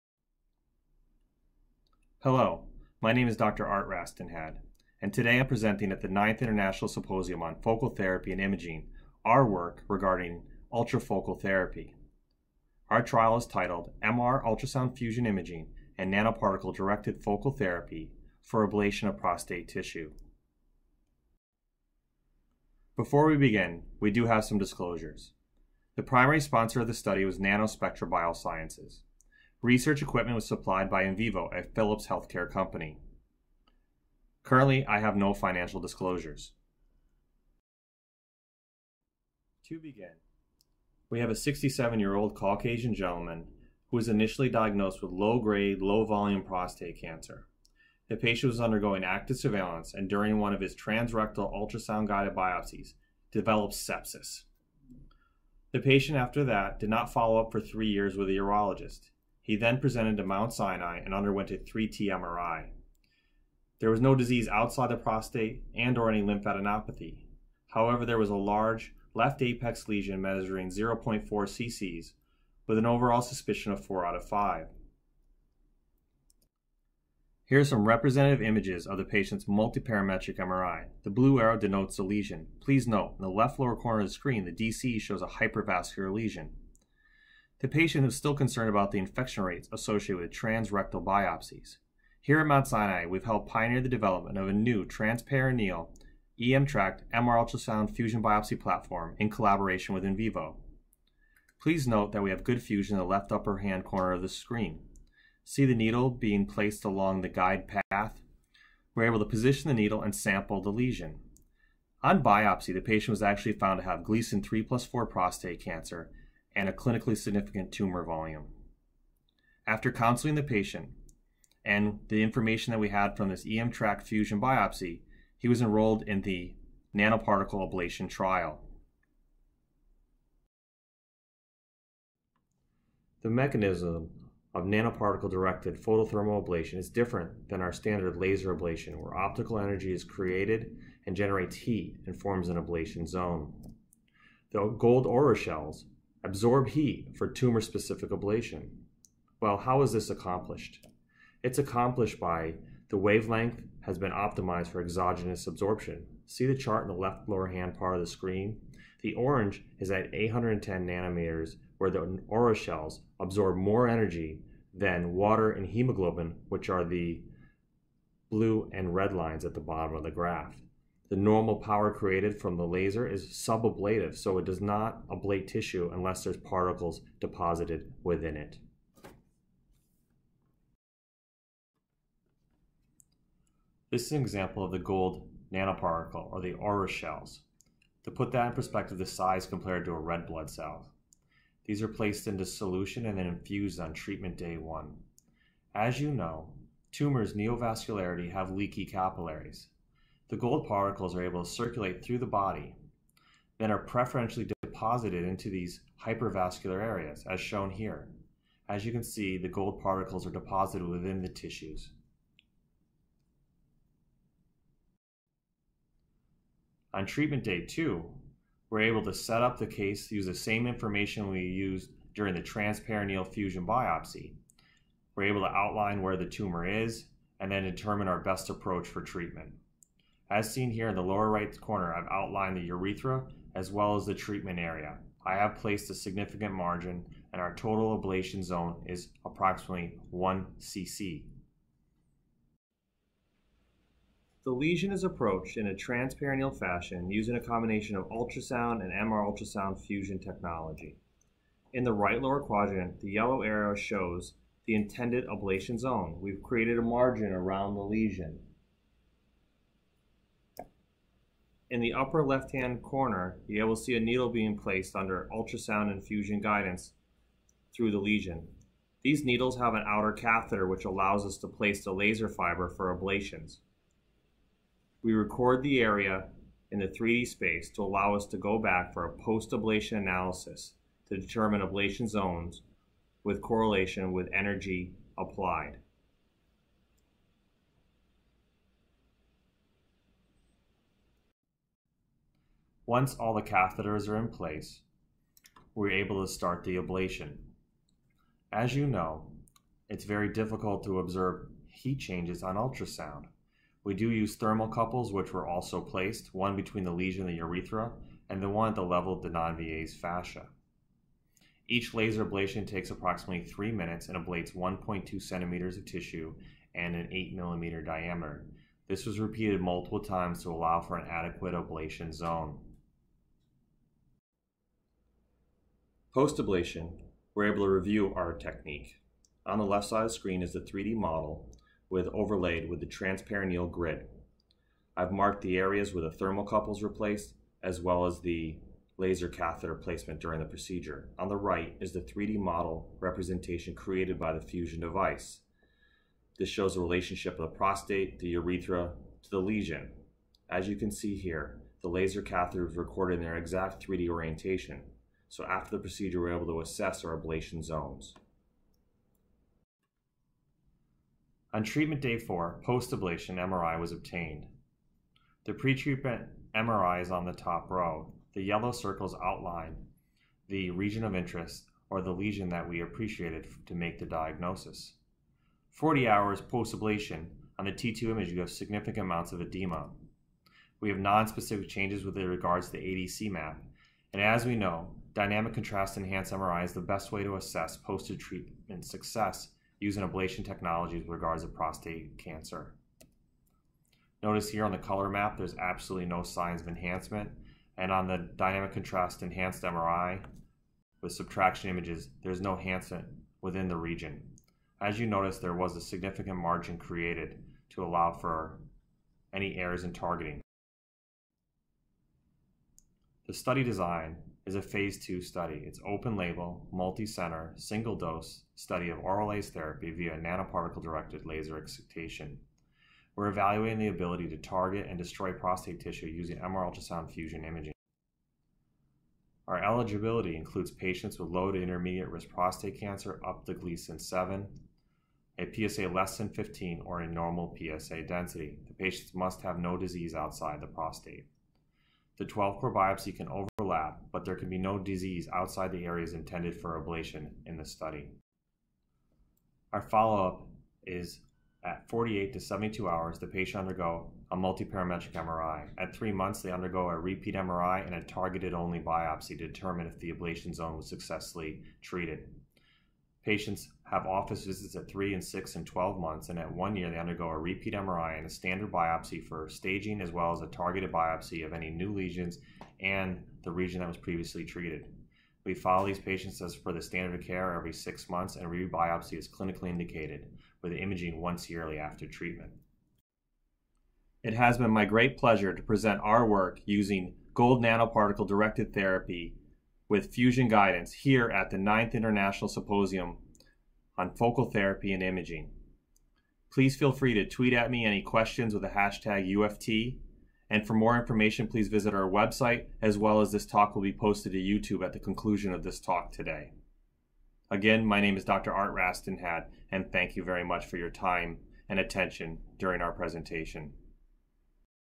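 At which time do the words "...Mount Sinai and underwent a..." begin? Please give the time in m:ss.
1:00.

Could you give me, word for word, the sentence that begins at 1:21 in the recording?
The blue arrow denotes the lesion.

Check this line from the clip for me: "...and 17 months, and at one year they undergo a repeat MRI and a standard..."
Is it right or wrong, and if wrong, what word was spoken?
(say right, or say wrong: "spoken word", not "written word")
wrong: "12", not "17".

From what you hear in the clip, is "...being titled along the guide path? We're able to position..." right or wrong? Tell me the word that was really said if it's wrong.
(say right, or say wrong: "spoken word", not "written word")
wrong: "placed", not "titled".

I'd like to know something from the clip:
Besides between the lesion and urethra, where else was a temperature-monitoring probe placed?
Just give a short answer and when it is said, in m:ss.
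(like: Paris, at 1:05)
Denonvilliers' fascia, at 5:09.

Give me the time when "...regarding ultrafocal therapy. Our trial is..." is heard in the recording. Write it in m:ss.
0:09.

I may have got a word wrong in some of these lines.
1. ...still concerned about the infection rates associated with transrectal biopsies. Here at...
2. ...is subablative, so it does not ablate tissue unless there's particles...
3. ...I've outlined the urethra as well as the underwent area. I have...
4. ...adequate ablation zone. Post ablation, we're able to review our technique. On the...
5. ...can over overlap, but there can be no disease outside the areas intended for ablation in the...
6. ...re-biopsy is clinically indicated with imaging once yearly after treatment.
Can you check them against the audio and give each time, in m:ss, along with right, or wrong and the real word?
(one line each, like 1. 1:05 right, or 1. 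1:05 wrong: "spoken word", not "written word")
1. 1:28 right
2. 2:53 right
3. 3:51 wrong: "treatment", not "underwent"
4. 5:21 right
5. 7:23 right
6. 7:58 right.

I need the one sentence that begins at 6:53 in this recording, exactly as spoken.
The study design is a phase 2 study.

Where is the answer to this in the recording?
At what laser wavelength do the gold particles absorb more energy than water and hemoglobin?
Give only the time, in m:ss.
2:40.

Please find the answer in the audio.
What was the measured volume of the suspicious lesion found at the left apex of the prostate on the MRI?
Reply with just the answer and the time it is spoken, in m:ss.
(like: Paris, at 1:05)
0.4 cc, at 1:10.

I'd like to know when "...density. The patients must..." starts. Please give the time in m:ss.
7:18.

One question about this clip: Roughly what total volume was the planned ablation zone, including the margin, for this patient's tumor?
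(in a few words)
1 cc.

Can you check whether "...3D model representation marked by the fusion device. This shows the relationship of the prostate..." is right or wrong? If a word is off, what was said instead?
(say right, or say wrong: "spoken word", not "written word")
wrong: "created", not "marked".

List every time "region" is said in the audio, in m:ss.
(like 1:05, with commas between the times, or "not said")
6:10, 6:43, 7:53.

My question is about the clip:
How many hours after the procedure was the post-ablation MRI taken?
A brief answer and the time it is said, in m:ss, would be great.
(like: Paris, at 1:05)
40, at 6:15.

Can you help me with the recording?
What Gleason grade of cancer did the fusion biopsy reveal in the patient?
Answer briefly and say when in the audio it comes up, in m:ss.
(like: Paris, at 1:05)
3 plus 4, at 1:54.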